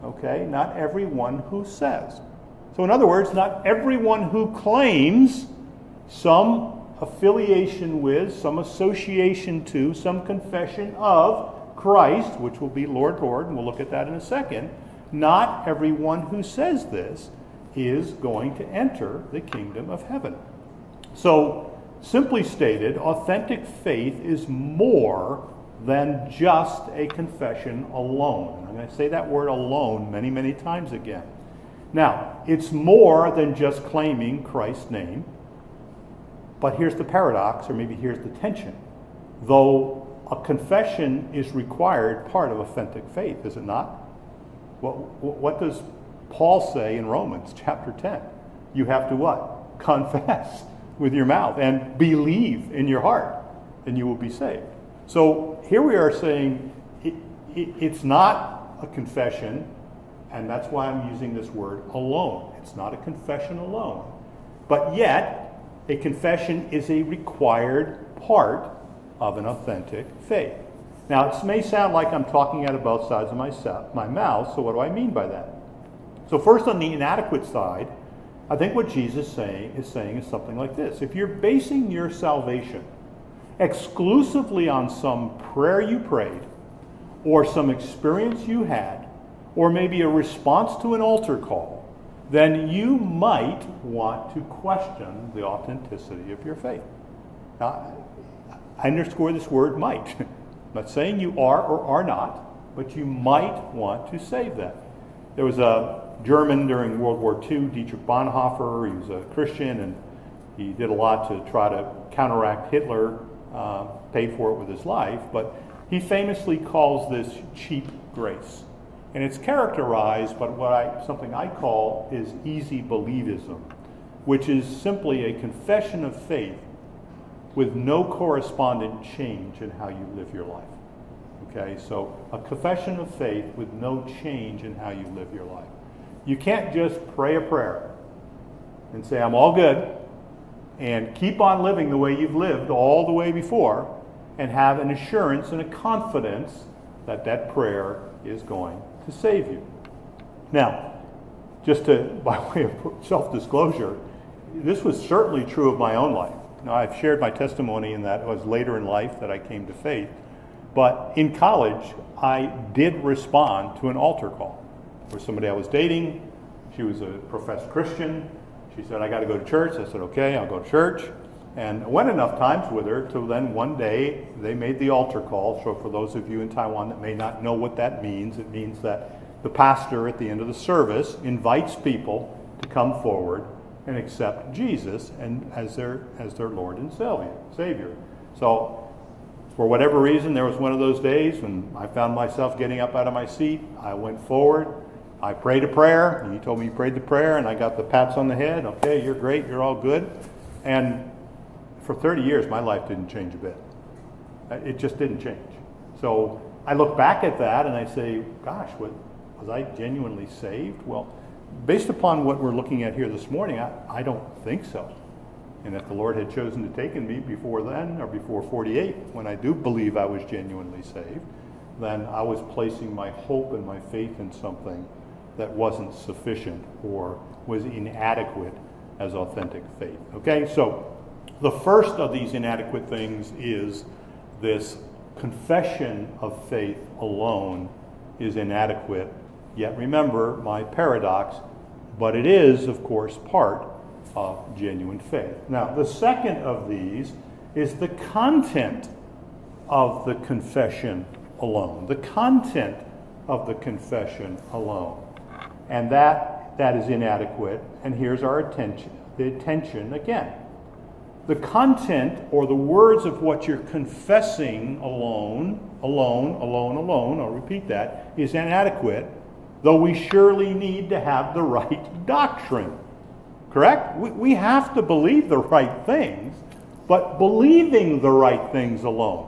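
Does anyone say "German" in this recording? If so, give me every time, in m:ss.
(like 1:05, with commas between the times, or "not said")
1:46.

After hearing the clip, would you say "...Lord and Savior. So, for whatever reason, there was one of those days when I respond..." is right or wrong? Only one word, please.
wrong.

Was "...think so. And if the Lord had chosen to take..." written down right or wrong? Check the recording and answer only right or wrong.
right.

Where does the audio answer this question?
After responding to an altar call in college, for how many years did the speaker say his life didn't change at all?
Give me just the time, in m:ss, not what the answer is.
3:21.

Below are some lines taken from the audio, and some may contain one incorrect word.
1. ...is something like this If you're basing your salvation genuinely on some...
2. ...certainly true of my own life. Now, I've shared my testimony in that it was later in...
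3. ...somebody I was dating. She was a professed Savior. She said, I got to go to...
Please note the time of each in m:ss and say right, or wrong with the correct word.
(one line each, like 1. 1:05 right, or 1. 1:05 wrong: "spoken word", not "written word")
1. 1:20 wrong: "exclusively", not "genuinely"
2. 2:34 right
3. 2:45 wrong: "Christian", not "Savior".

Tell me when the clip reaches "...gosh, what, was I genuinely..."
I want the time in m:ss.
3:28.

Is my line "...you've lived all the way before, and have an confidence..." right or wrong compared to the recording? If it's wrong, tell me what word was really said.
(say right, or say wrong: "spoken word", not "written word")
wrong: "assurance", not "confidence".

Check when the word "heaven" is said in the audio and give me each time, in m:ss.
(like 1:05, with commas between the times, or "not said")
0:20.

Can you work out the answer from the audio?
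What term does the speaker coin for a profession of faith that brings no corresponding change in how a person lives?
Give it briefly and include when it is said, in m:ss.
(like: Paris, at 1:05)
easy believism, at 2:02.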